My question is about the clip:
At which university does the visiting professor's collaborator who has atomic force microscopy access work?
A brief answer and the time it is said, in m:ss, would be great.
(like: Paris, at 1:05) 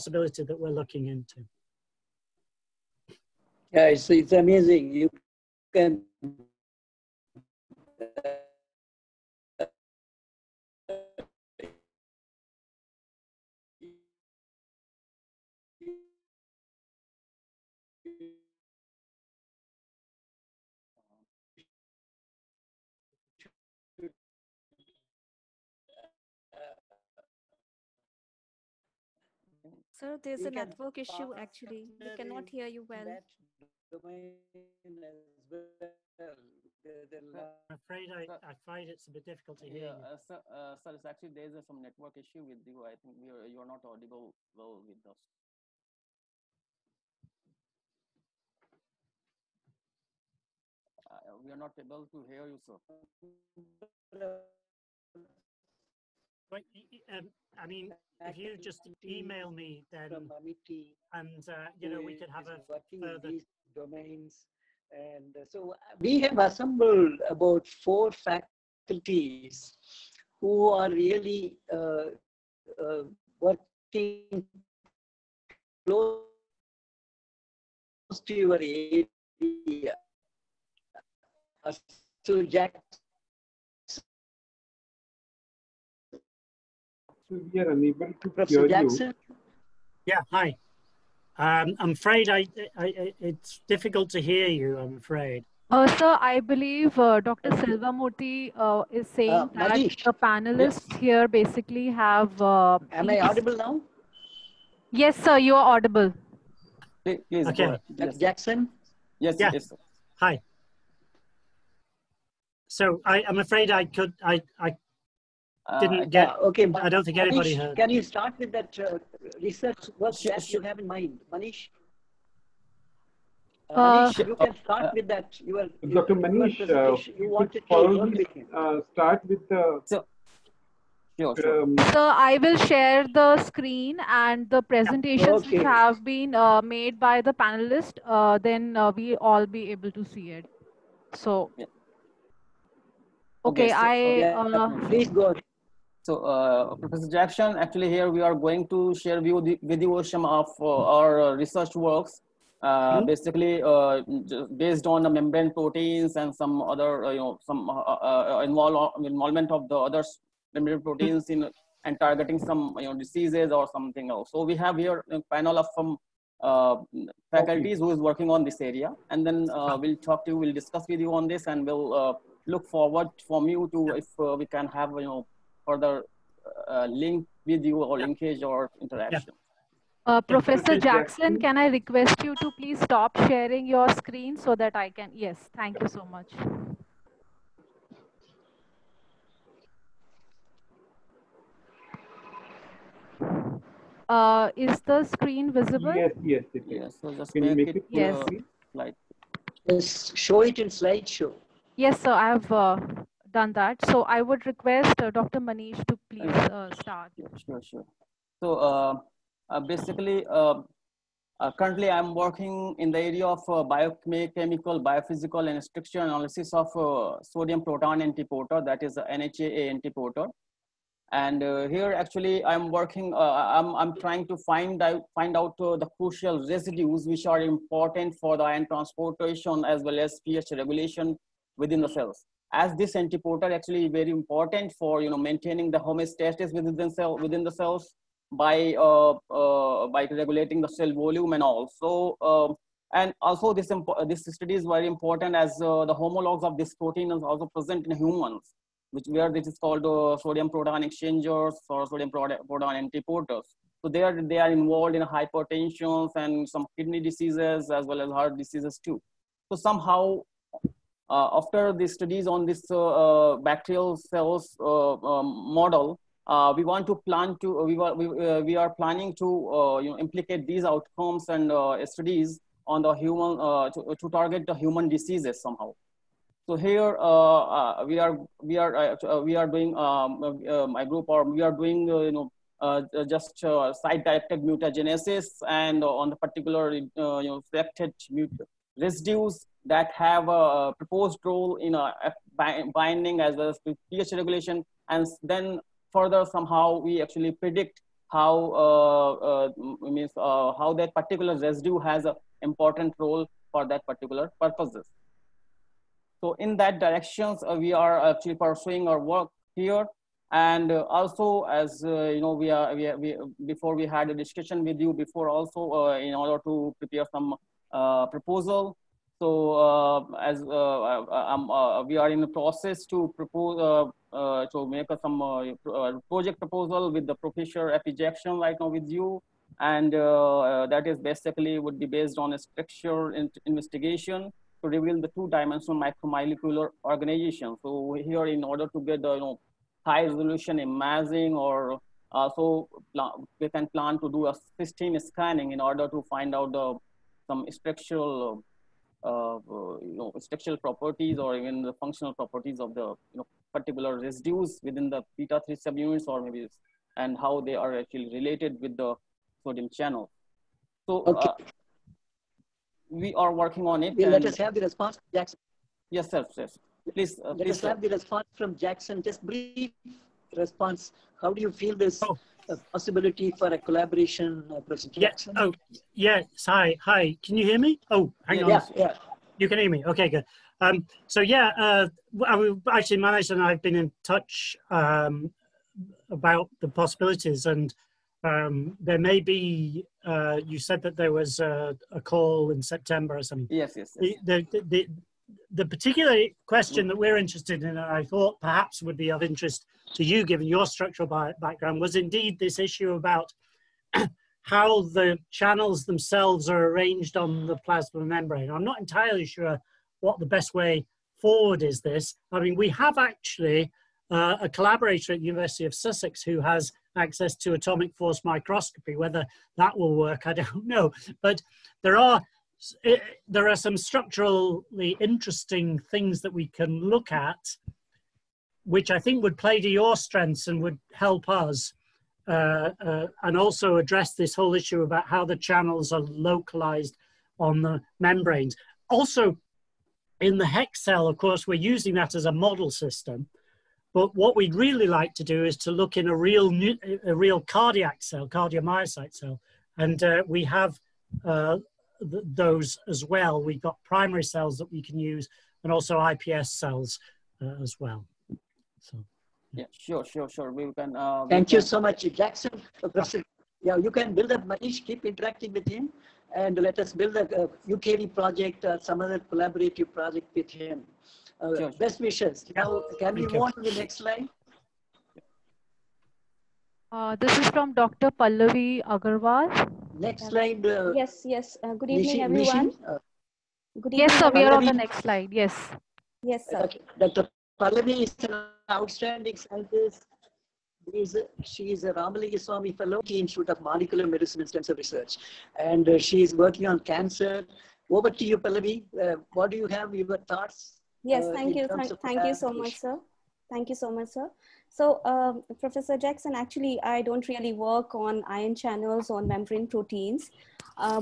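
University of Sussex, at 6:55.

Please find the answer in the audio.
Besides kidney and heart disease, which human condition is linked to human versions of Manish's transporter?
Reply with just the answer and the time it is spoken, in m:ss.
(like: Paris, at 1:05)
Hypertension, at 4:15.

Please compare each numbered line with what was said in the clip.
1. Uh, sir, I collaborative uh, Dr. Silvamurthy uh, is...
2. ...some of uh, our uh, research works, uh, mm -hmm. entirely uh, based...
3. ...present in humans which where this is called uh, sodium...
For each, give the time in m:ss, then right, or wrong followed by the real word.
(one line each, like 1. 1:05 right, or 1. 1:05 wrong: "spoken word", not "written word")
1. 1:35 wrong: "believe", not "collaborative"
2. 2:30 wrong: "basically", not "entirely"
3. 4:07 right.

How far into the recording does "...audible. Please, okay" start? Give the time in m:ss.
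1:45.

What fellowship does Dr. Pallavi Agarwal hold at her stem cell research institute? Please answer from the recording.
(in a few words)
Ramalingaswami Fellow.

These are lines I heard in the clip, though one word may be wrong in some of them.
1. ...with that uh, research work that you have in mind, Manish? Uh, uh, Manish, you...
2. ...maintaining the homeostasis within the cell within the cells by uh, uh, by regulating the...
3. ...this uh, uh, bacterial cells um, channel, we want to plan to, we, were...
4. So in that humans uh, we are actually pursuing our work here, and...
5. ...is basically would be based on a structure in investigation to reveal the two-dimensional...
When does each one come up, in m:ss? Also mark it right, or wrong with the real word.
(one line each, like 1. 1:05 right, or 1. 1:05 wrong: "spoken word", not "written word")
1. 1:58 right
2. 3:55 right
3. 4:22 wrong: "model", not "channel"
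4. 5:06 wrong: "directions", not "humans"
5. 5:30 right.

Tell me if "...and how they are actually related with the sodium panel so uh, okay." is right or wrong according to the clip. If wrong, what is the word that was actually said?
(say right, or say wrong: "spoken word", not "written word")
wrong: "channel", not "panel".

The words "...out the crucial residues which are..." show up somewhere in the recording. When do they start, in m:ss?
3:45.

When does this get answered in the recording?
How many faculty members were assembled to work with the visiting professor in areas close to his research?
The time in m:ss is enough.
1:07.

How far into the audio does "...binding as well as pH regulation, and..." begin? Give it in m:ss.
4:52.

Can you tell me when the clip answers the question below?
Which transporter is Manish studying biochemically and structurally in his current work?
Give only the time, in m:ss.
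3:37.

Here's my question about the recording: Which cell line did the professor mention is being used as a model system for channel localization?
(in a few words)
HEK cell.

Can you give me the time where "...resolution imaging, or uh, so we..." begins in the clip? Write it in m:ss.
5:40.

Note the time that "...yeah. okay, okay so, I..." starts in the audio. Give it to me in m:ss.
2:21.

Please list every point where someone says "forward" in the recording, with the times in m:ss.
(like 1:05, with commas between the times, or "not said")
2:52, 6:51.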